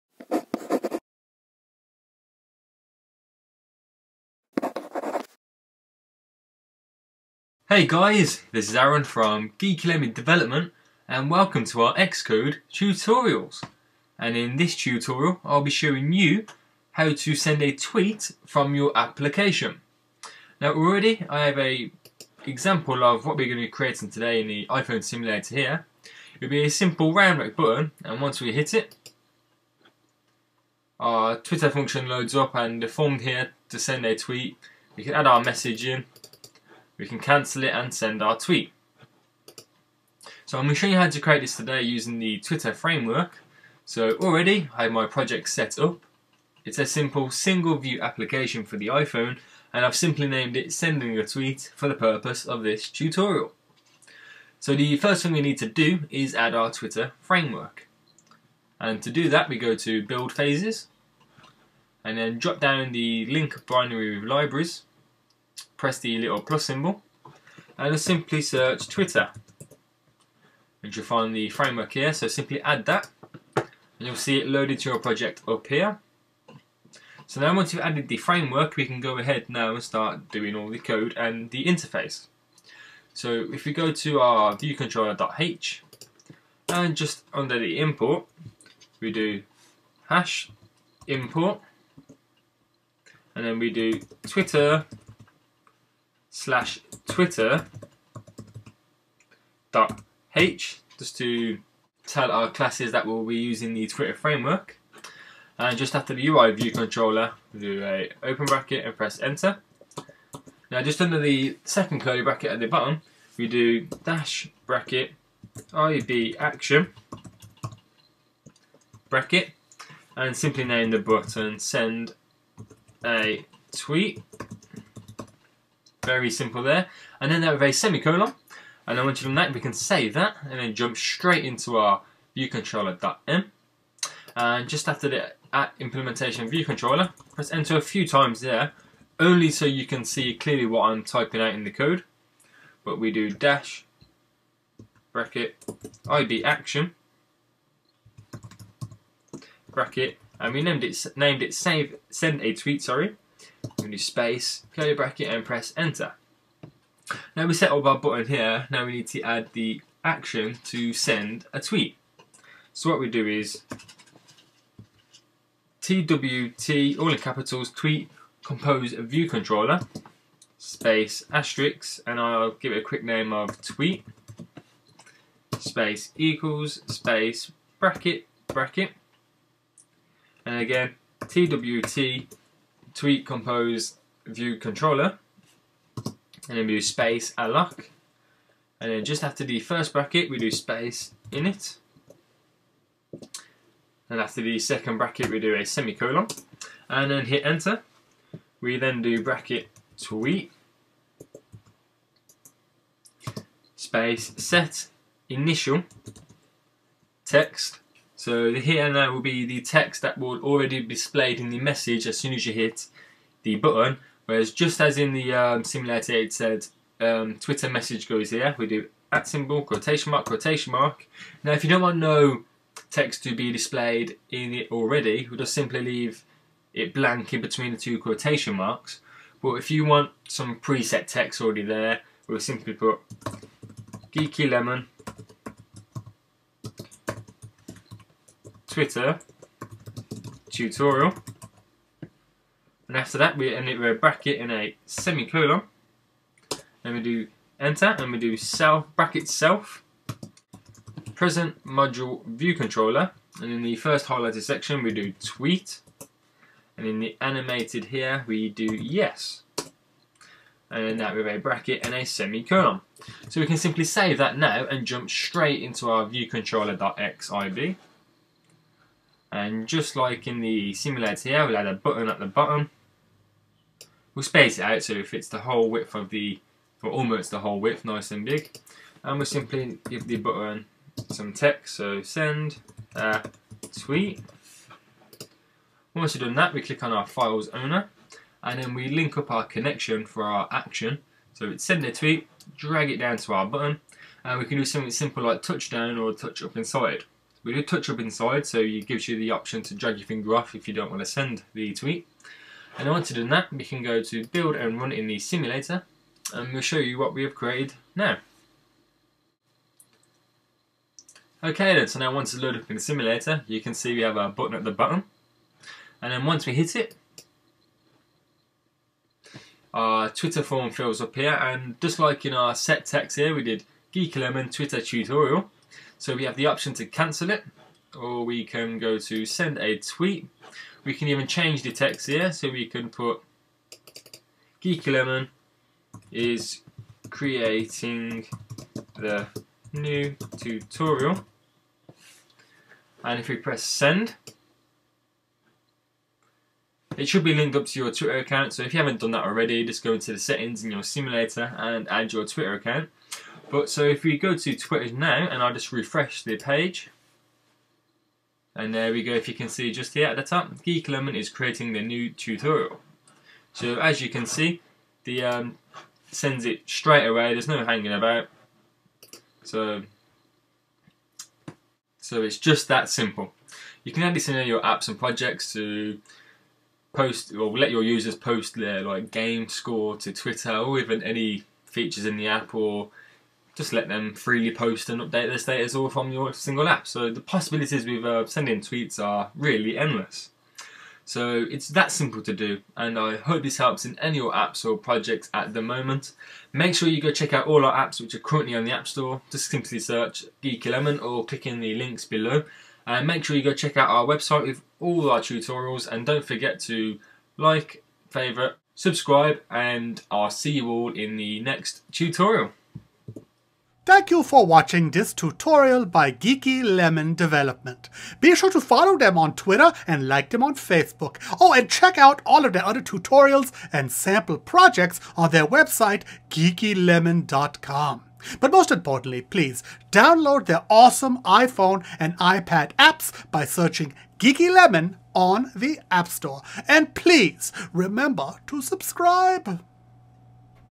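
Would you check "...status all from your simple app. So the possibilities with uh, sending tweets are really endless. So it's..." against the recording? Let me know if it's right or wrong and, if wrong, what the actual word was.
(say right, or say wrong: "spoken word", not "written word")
wrong: "single", not "simple".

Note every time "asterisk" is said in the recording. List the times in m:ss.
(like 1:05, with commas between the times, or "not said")
2:51.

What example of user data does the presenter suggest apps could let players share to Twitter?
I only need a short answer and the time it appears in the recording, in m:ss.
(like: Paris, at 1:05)
Game score, at 6:19.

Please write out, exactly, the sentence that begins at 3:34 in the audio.
Whereas just as in the um, simulator it said um, Twitter message goes here, we do at symbol, quotation mark, quotation mark.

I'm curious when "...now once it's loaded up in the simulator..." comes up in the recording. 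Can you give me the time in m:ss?
5:11.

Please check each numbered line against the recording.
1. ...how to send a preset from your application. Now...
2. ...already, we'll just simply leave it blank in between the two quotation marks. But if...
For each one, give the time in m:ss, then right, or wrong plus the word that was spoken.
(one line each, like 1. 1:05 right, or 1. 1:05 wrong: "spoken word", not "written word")
1. 0:16 wrong: "tweet", not "preset"
2. 3:44 right.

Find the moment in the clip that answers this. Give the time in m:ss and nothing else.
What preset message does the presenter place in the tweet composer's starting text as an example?
3:54.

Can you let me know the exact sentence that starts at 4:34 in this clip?
We'll space it out so it fits the whole width of the, or almost the whole width, nice and big.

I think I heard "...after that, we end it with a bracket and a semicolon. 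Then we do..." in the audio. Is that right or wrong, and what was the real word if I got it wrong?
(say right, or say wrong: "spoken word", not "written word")
right.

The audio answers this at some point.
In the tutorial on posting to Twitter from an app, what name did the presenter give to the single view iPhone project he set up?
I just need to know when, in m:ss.
0:50.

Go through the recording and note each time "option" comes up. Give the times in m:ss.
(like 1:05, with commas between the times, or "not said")
4:59, 5:26.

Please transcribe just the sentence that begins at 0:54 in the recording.
So the first thing we need to do is add our Twitter framework.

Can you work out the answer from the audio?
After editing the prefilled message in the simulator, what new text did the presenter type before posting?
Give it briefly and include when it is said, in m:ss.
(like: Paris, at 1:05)
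Geeky Lemon is creating the new tutorial, at 5:34.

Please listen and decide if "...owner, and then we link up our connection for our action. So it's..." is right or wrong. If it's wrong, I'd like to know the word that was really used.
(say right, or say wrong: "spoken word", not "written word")
right.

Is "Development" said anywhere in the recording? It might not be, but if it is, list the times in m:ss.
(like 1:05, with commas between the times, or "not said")
0:10, 6:57.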